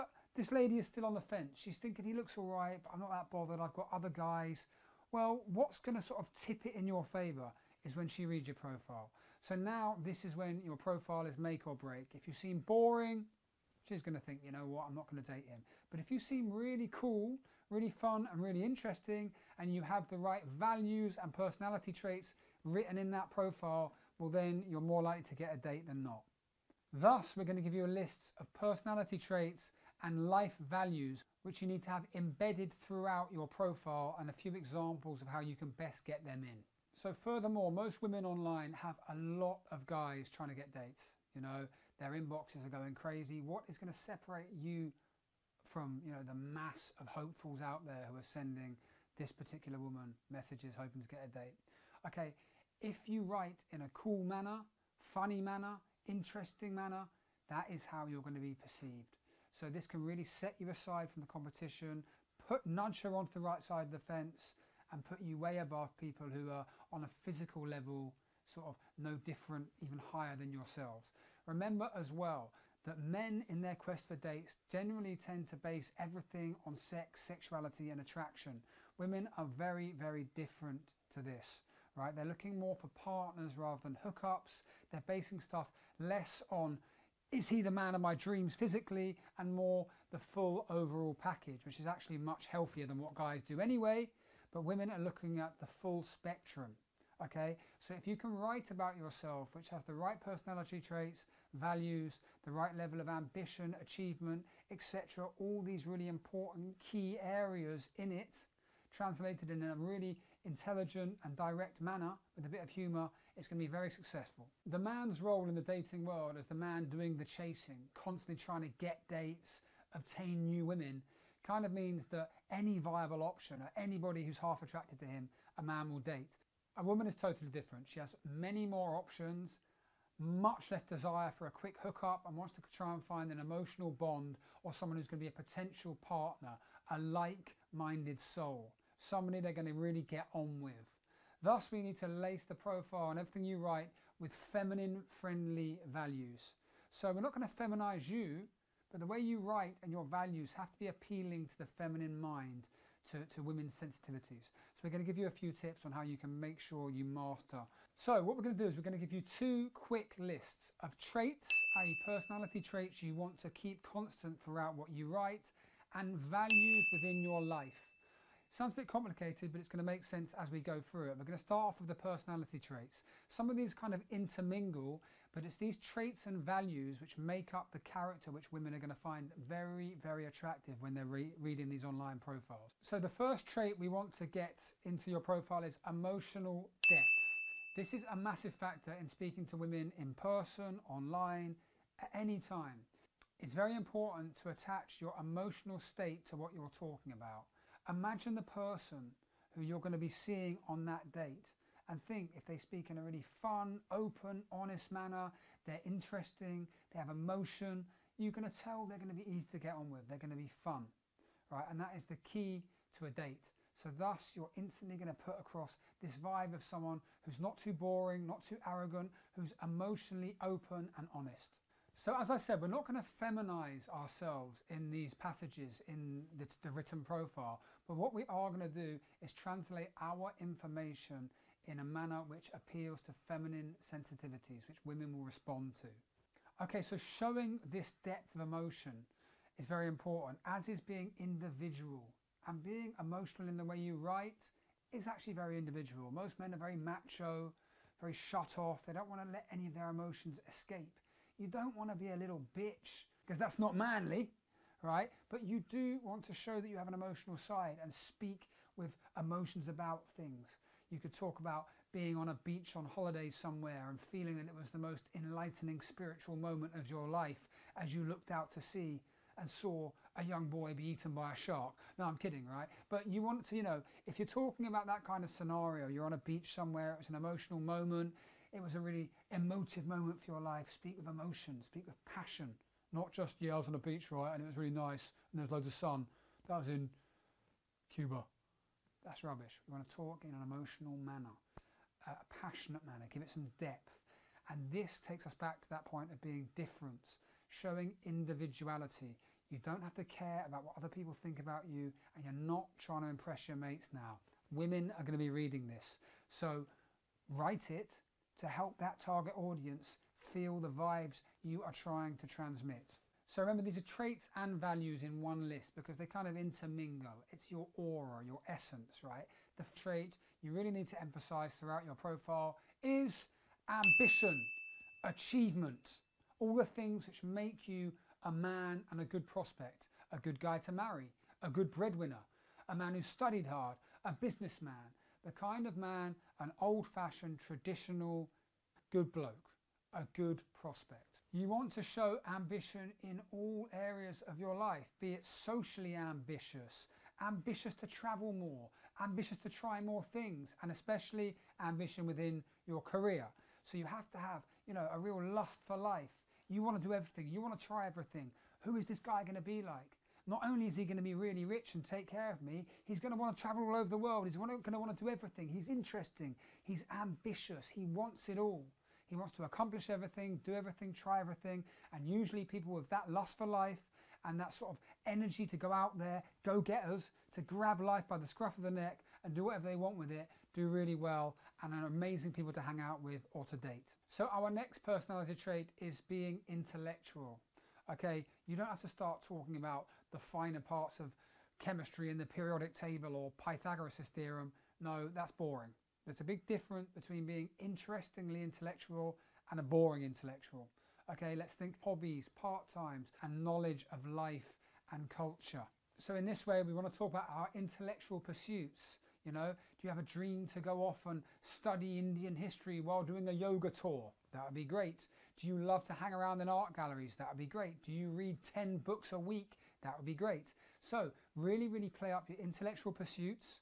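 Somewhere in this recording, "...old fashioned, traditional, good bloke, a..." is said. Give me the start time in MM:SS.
05:36.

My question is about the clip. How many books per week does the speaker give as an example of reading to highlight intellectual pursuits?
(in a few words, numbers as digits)
10.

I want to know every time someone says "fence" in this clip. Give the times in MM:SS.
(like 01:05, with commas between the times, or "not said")
00:01, 01:04.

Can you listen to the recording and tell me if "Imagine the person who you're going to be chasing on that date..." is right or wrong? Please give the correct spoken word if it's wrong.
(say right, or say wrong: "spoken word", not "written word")
wrong: "seeing", not "chasing".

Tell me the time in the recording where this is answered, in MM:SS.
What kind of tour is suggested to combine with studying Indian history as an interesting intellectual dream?
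06:53.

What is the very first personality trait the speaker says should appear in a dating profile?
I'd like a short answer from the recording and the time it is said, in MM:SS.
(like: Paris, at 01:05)
Emotional depth, at 03:05.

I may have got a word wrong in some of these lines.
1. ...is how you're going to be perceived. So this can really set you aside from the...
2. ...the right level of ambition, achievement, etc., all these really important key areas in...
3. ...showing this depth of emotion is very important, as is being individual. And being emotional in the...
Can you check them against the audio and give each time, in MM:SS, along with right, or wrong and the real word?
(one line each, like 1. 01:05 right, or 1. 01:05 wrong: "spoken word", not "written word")
1. 00:57 right
2. 01:42 right
3. 03:57 right.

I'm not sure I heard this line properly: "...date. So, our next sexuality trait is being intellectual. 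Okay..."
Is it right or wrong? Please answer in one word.
wrong.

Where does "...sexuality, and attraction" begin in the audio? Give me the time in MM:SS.
01:17.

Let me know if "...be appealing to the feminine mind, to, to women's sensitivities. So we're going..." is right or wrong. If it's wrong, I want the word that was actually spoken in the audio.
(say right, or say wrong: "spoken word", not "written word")
right.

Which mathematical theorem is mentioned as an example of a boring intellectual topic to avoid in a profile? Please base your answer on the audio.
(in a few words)
Pythagoras' theorem.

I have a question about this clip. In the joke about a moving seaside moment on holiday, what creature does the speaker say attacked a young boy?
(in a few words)
A shark.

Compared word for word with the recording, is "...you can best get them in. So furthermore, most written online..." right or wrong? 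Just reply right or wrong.
wrong.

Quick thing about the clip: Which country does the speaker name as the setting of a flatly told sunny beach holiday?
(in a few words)
Cuba.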